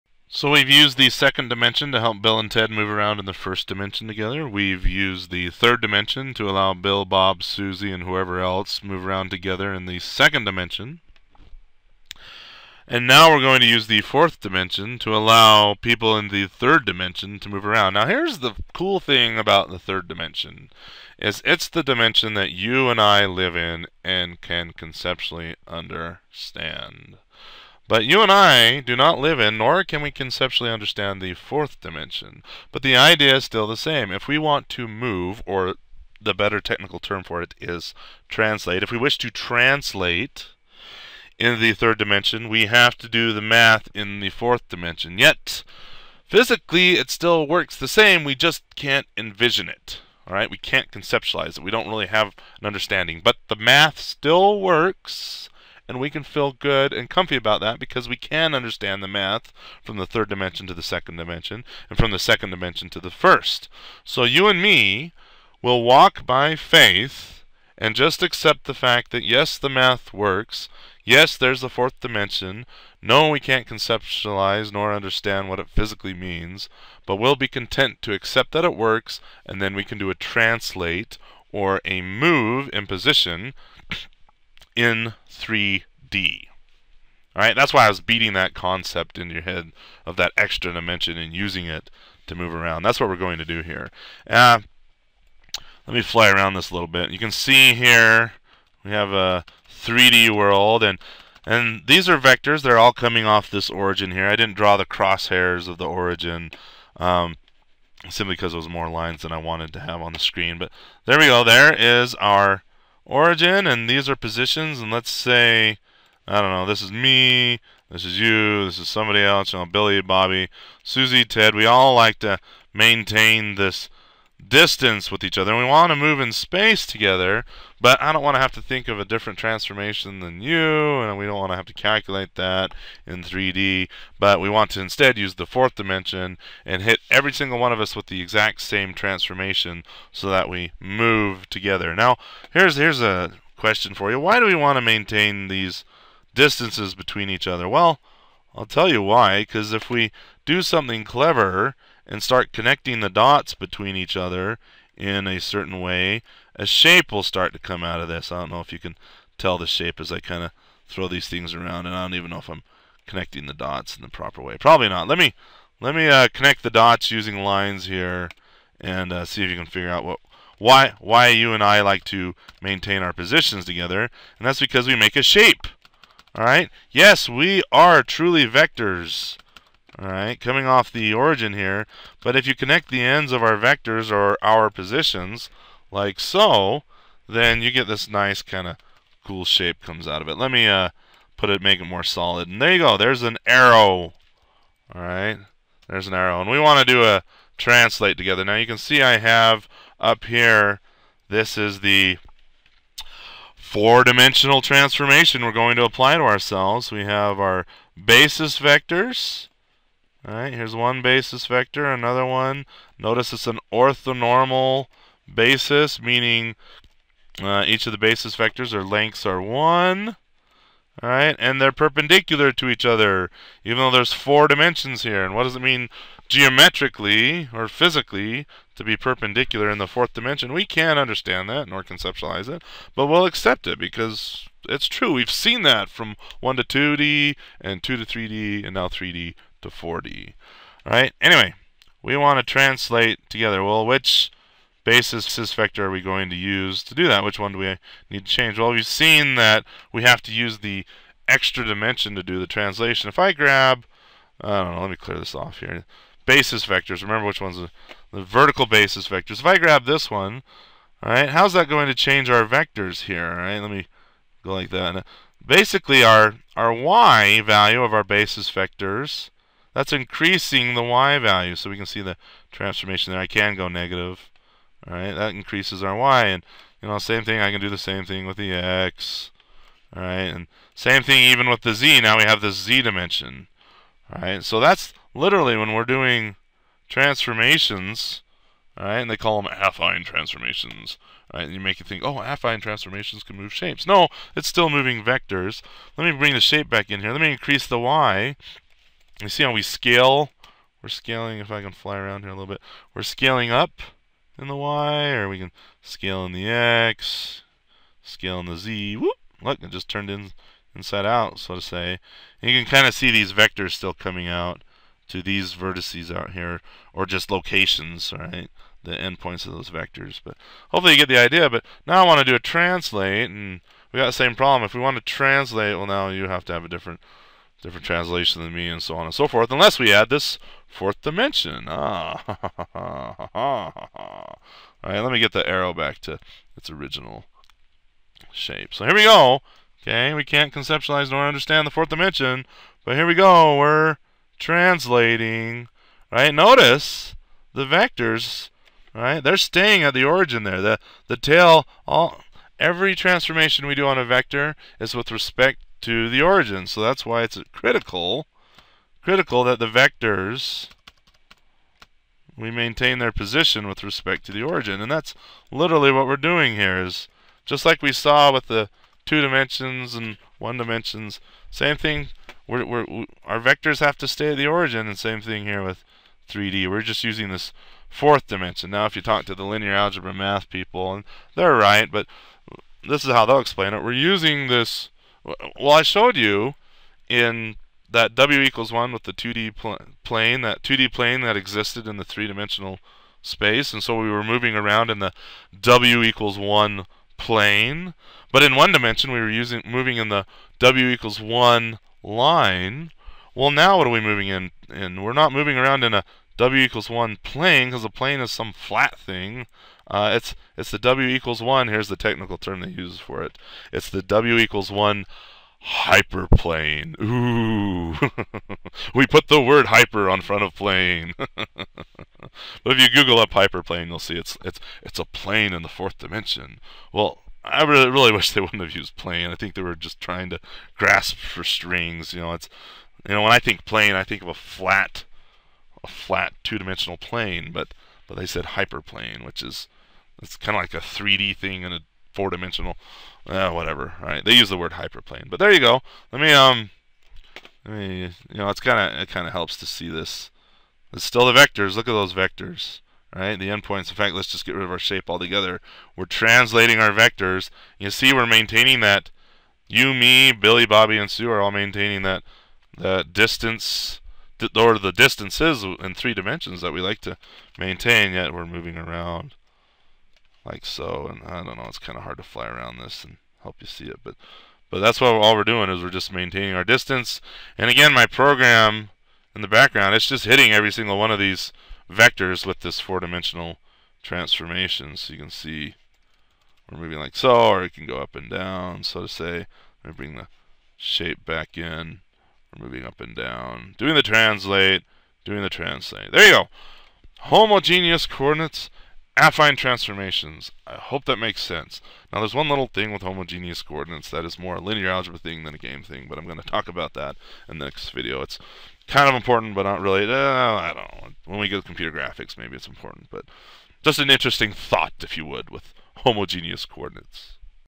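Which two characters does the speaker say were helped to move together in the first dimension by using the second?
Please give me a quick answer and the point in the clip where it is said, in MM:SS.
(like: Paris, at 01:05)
Bill and Ted, at 00:02.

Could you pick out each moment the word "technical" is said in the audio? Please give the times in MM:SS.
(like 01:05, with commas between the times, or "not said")
00:36, 06:51.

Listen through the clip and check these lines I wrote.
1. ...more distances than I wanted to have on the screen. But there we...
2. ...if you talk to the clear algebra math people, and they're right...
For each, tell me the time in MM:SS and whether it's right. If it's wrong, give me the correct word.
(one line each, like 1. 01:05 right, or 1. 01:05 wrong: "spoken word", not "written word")
1. 01:48 wrong: "lines", not "distances"
2. 06:18 wrong: "linear", not "clear".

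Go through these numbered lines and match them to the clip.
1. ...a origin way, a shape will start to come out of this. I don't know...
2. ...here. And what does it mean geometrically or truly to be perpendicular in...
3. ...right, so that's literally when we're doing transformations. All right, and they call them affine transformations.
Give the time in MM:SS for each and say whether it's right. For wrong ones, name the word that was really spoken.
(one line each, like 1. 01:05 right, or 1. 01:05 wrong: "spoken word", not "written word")
1. 02:35 wrong: "certain", not "origin"
2. 03:45 wrong: "physically", not "truly"
3. 04:44 right.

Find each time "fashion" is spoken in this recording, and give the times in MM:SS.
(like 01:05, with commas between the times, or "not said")
not said.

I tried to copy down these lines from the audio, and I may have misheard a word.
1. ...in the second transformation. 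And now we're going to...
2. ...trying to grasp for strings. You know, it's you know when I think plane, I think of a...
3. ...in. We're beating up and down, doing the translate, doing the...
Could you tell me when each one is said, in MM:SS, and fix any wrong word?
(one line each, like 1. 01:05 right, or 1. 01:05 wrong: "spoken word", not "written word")
1. 00:09 wrong: "dimension", not "transformation"
2. 07:09 right
3. 08:11 wrong: "moving", not "beating".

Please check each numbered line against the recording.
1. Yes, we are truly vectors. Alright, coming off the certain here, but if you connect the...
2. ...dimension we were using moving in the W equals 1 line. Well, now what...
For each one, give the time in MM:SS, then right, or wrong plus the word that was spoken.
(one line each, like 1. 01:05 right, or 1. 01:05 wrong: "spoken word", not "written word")
1. 02:56 wrong: "origin", not "certain"
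2. 06:38 right.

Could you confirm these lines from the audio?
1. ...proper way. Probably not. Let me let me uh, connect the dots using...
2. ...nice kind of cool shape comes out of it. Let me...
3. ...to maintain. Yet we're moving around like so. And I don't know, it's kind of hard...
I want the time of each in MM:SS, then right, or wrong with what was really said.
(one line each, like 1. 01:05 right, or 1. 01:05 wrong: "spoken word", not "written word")
1. 02:44 right
2. 03:08 right
3. 07:47 right.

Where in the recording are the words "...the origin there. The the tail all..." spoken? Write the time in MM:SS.
05:49.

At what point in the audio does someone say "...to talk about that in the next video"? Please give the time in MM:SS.
08:26.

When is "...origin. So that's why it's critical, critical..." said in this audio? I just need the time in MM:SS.
05:56.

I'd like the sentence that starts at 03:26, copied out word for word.
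We have our basis vectors, Alright, here's one basis vector, another one.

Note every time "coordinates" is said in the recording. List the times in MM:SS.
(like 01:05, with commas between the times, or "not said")
08:18, 08:23, 08:36.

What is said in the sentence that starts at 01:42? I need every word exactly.
They're all coming off this origin here.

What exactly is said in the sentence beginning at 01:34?
Uh, let me fly around this a little bit.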